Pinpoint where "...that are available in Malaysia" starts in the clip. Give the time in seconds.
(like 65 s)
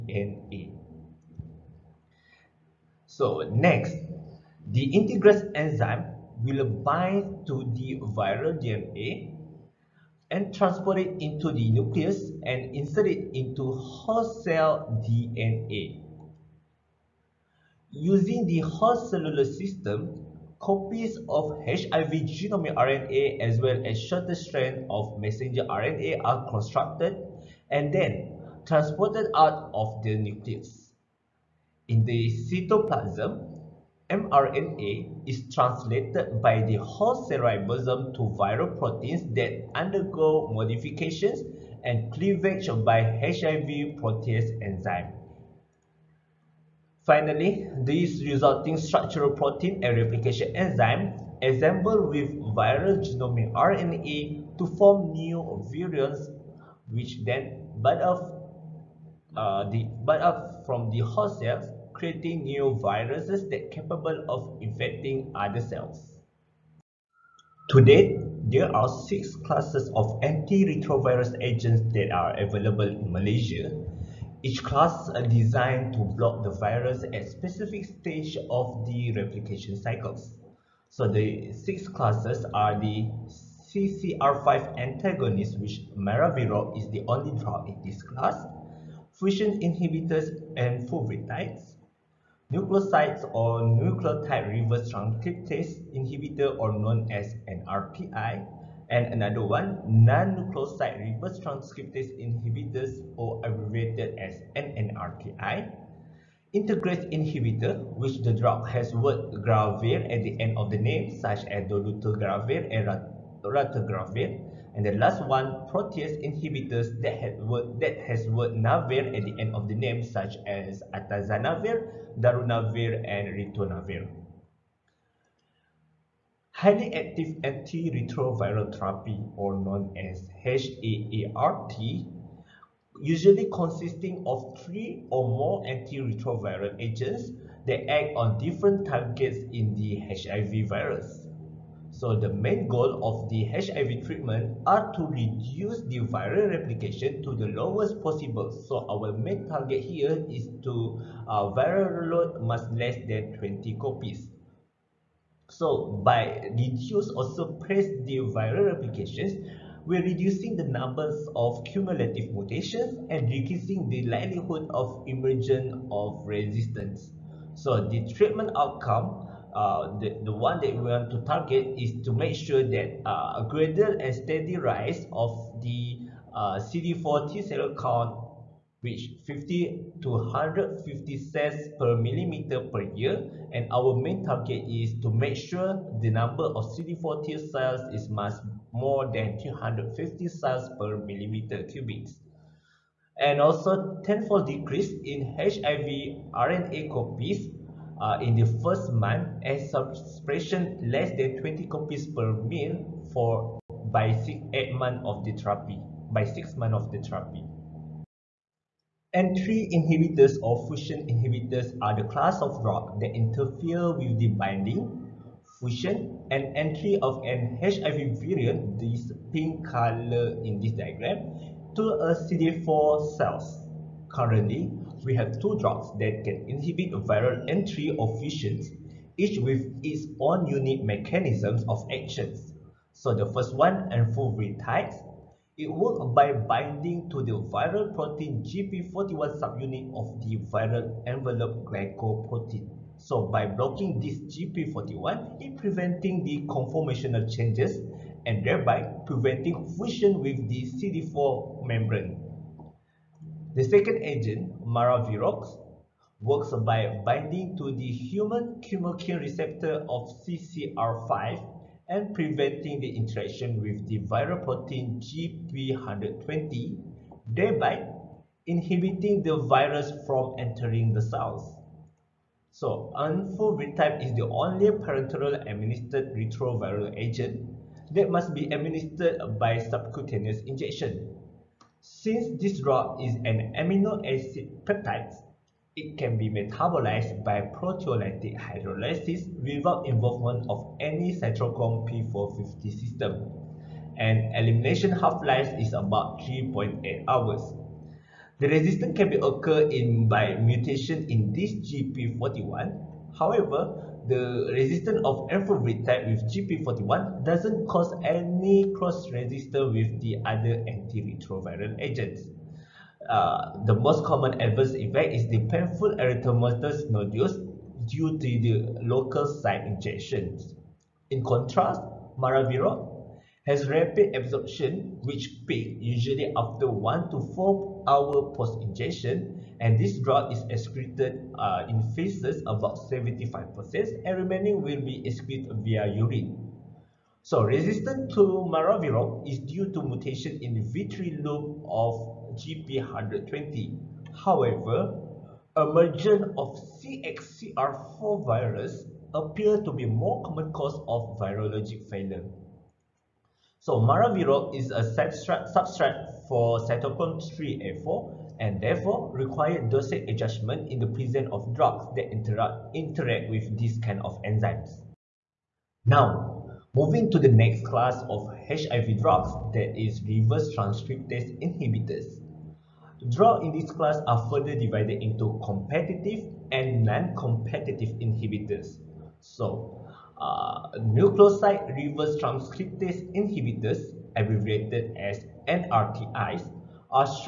71 s.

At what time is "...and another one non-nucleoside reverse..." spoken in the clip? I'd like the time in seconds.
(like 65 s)
98 s.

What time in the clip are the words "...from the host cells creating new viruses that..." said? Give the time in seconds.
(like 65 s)
60 s.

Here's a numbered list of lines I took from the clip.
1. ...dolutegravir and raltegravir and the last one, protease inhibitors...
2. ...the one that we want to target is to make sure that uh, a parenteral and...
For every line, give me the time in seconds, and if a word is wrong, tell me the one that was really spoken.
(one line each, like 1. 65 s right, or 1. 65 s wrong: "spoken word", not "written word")
1. 111 s right
2. 170 s wrong: "gradual", not "parenteral".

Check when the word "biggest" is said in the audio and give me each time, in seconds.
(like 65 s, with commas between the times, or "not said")
not said.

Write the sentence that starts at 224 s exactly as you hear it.
Currently, we have two drugs that can inhibit viral entry or fusions, each with its own unique mechanisms of actions.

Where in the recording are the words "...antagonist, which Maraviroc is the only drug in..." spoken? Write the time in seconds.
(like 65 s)
84 s.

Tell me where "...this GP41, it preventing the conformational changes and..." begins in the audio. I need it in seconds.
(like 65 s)
243 s.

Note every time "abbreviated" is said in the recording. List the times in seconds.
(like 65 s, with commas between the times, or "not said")
103 s, 384 s.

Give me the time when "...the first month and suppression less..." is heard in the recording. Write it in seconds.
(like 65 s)
198 s.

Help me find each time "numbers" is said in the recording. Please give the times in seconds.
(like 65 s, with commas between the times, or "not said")
160 s, 186 s.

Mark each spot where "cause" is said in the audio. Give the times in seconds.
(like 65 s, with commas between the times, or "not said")
307 s, 350 s.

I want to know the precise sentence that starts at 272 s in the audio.
So, enfuvirtide is the only parenteral administered retroviral agent that must be administered by subcutaneous injection.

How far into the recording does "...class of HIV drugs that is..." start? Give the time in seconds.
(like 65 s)
367 s.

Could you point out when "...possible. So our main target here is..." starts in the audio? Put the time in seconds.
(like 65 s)
148 s.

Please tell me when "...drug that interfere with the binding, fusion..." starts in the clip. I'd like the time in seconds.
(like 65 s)
212 s.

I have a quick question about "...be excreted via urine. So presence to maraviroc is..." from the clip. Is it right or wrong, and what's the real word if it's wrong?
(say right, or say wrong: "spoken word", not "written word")
wrong: "resistance", not "presence".